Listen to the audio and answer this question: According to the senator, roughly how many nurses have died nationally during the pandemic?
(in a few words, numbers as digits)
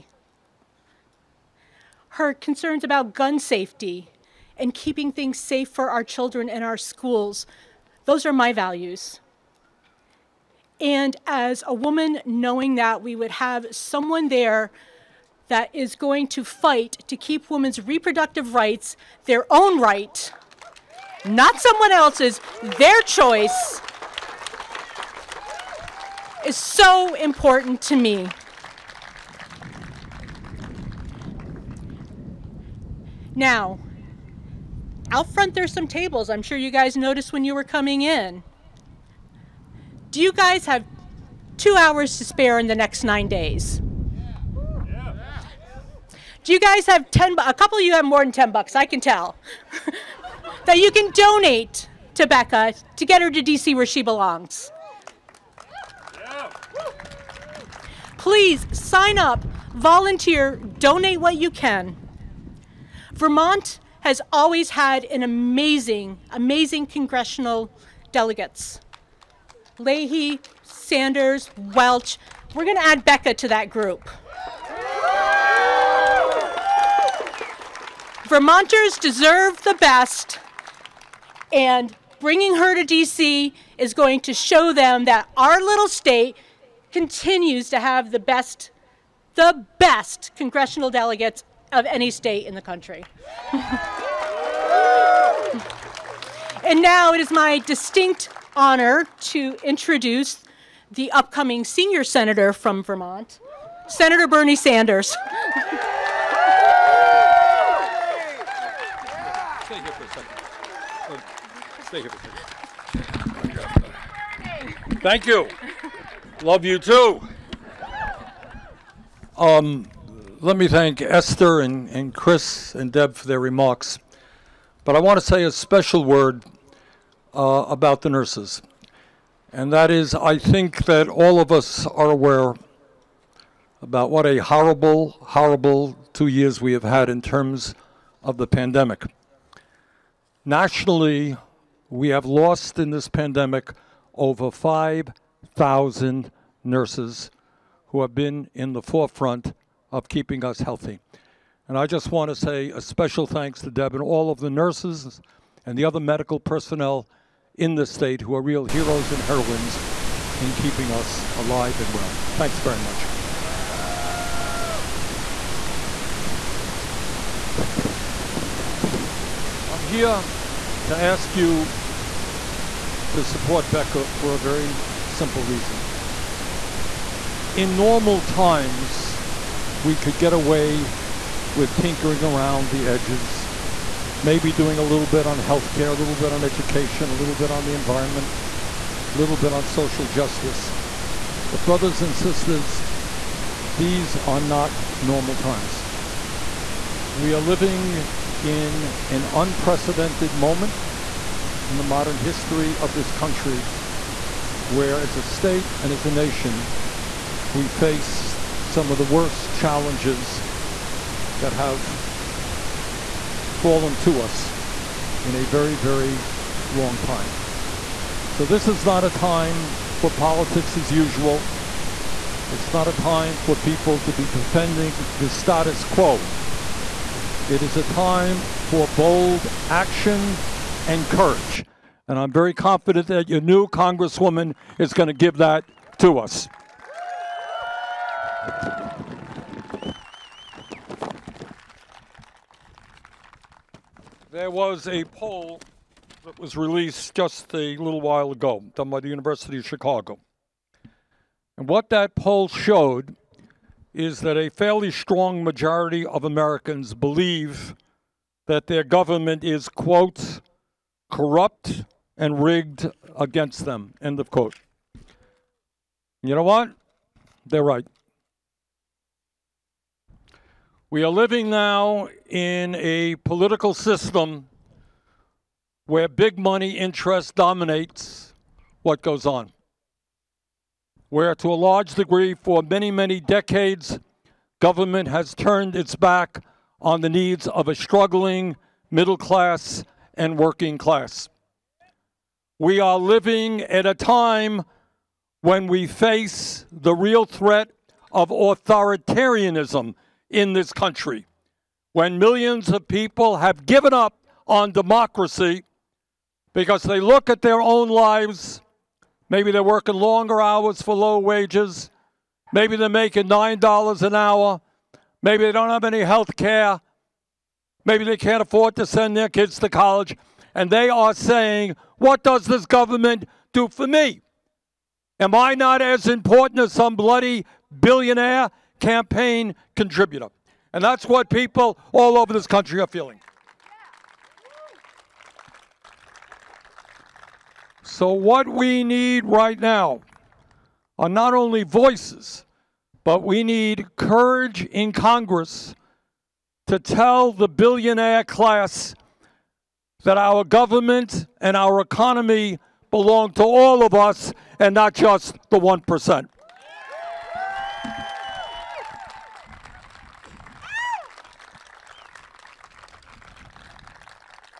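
over 5,000.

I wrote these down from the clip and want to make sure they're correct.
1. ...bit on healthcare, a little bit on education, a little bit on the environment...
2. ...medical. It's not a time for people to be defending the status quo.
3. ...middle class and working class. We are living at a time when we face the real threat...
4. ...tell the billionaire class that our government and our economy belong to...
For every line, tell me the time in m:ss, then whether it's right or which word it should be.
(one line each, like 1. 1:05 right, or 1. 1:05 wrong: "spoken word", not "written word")
1. 3:05 right
2. 3:40 wrong: "usual", not "medical"
3. 4:48 right
4. 5:46 right.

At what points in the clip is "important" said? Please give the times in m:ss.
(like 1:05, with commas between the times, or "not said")
0:27, 5:26.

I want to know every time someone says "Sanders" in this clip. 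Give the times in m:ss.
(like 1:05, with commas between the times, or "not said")
1:10, 1:44.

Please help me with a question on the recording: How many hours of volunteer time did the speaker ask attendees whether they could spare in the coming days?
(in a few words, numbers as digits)
2.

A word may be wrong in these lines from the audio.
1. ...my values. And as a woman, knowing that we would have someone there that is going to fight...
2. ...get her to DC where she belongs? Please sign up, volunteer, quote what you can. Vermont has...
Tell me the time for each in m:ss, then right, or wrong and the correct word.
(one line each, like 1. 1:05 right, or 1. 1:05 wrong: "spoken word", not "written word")
1. 0:08 right
2. 0:53 wrong: "donate", not "quote".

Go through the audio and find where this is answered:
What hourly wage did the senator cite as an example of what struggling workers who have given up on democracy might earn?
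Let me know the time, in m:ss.
5:13.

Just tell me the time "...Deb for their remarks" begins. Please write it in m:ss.
2:02.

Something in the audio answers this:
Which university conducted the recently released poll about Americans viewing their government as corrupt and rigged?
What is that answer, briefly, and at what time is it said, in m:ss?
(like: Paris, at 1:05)
University of Chicago, at 4:09.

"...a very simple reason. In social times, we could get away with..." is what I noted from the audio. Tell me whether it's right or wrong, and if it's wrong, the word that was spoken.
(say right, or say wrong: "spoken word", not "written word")
wrong: "normal", not "social".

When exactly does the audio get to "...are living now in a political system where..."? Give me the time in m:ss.
4:31.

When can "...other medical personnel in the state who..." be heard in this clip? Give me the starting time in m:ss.
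2:35.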